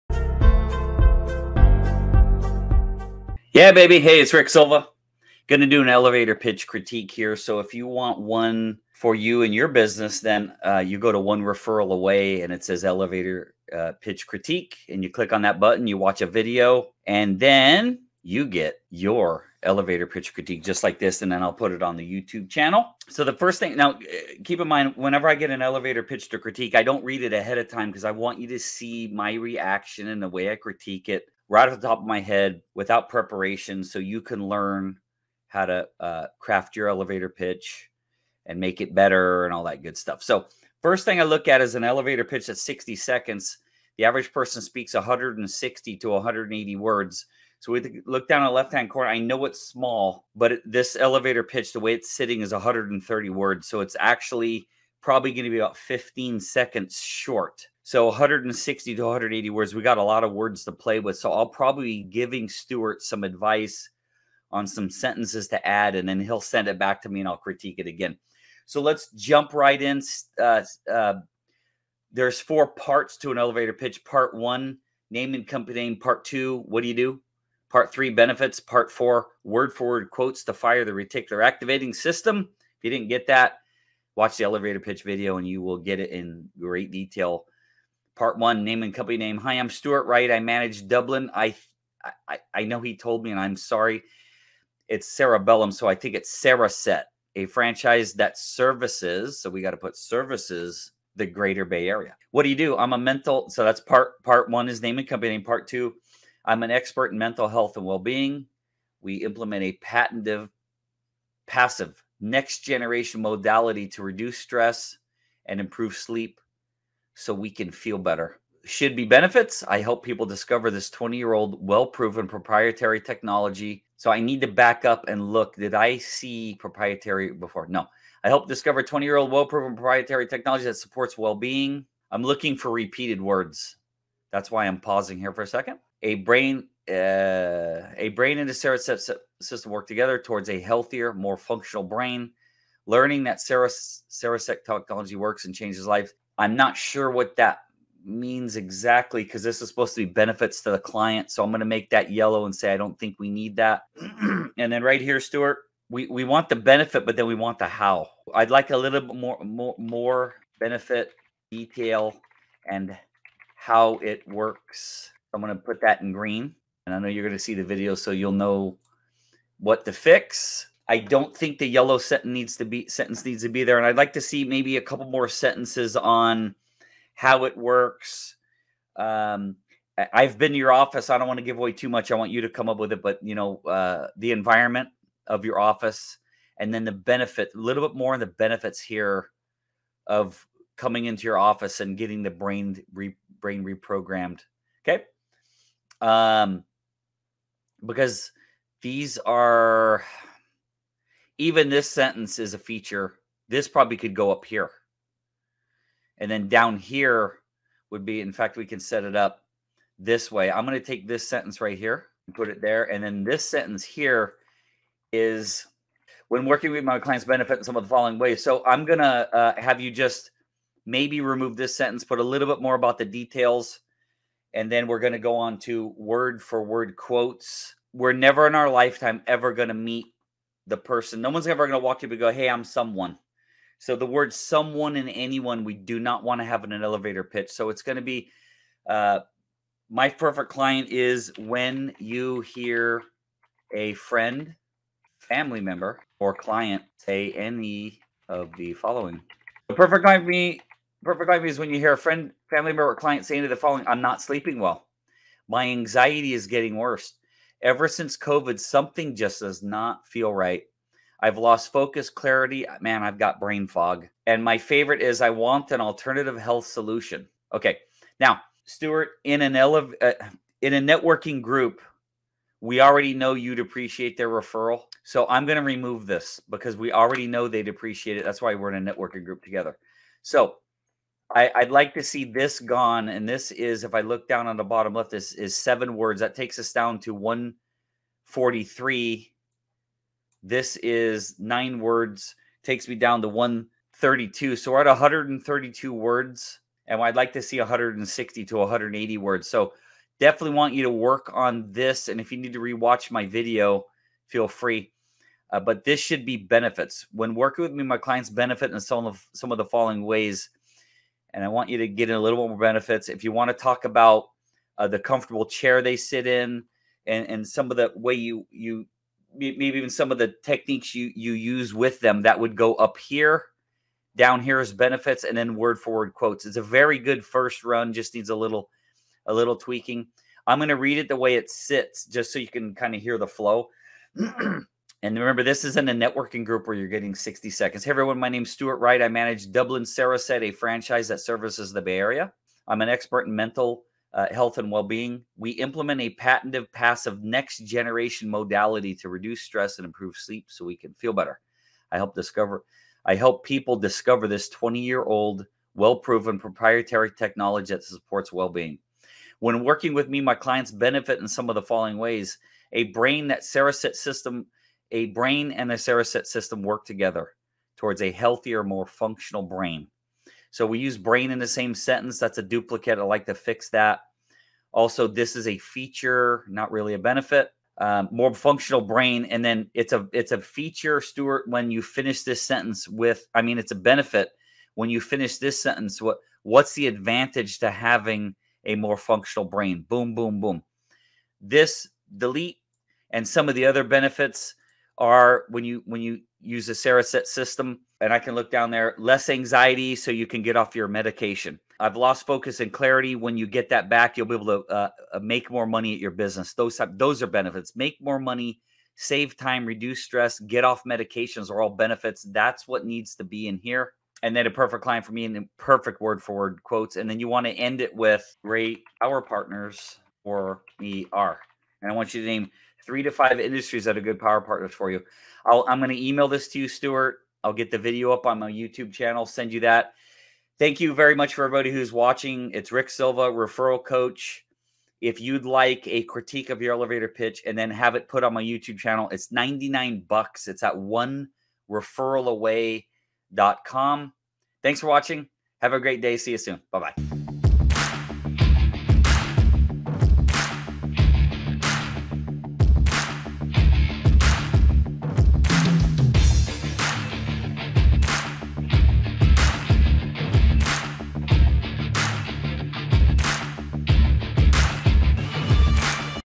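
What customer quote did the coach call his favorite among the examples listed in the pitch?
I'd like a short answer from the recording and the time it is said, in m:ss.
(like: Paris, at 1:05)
I want an alternative health solution, at 4:25.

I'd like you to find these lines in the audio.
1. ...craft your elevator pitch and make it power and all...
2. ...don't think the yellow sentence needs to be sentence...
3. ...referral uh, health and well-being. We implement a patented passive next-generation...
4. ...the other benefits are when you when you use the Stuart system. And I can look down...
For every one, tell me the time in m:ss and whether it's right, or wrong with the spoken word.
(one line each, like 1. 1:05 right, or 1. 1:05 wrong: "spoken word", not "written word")
1. 0:36 wrong: "better", not "power"
2. 2:50 right
3. 5:43 wrong: "mental", not "referral"
4. 6:33 wrong: "Cereset", not "Stuart".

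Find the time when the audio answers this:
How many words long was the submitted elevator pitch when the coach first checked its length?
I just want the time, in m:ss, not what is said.
0:52.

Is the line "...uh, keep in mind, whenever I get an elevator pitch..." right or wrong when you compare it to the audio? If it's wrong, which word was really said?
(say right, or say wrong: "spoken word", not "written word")
right.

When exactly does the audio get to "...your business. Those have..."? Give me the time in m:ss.
6:45.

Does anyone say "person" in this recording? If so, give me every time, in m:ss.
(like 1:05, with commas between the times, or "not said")
0:44, 3:50.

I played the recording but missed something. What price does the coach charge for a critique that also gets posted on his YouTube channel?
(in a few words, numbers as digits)
$99.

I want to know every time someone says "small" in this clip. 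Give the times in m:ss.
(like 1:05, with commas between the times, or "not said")
0:49.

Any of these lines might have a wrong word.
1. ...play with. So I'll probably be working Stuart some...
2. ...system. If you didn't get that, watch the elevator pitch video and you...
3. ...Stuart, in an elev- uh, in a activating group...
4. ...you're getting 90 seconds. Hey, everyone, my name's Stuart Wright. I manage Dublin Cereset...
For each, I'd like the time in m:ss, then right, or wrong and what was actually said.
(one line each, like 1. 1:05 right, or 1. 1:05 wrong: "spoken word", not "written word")
1. 1:00 wrong: "giving", not "working"
2. 1:21 right
3. 4:28 wrong: "networking", not "activating"
4. 5:36 wrong: "60", not "90".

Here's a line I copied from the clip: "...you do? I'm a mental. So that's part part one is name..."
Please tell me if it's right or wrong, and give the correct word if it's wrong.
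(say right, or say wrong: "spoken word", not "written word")
right.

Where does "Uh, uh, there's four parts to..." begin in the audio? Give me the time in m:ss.
1:10.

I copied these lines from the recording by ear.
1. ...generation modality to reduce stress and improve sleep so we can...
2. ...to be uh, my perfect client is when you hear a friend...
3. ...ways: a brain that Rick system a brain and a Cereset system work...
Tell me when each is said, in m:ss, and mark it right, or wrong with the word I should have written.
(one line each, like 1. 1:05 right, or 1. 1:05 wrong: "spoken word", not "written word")
1. 1:52 right
2. 3:57 right
3. 6:01 wrong: "Cereset", not "Rick".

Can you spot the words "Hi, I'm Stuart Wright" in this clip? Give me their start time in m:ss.
1:29.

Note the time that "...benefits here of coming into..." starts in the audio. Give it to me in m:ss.
3:08.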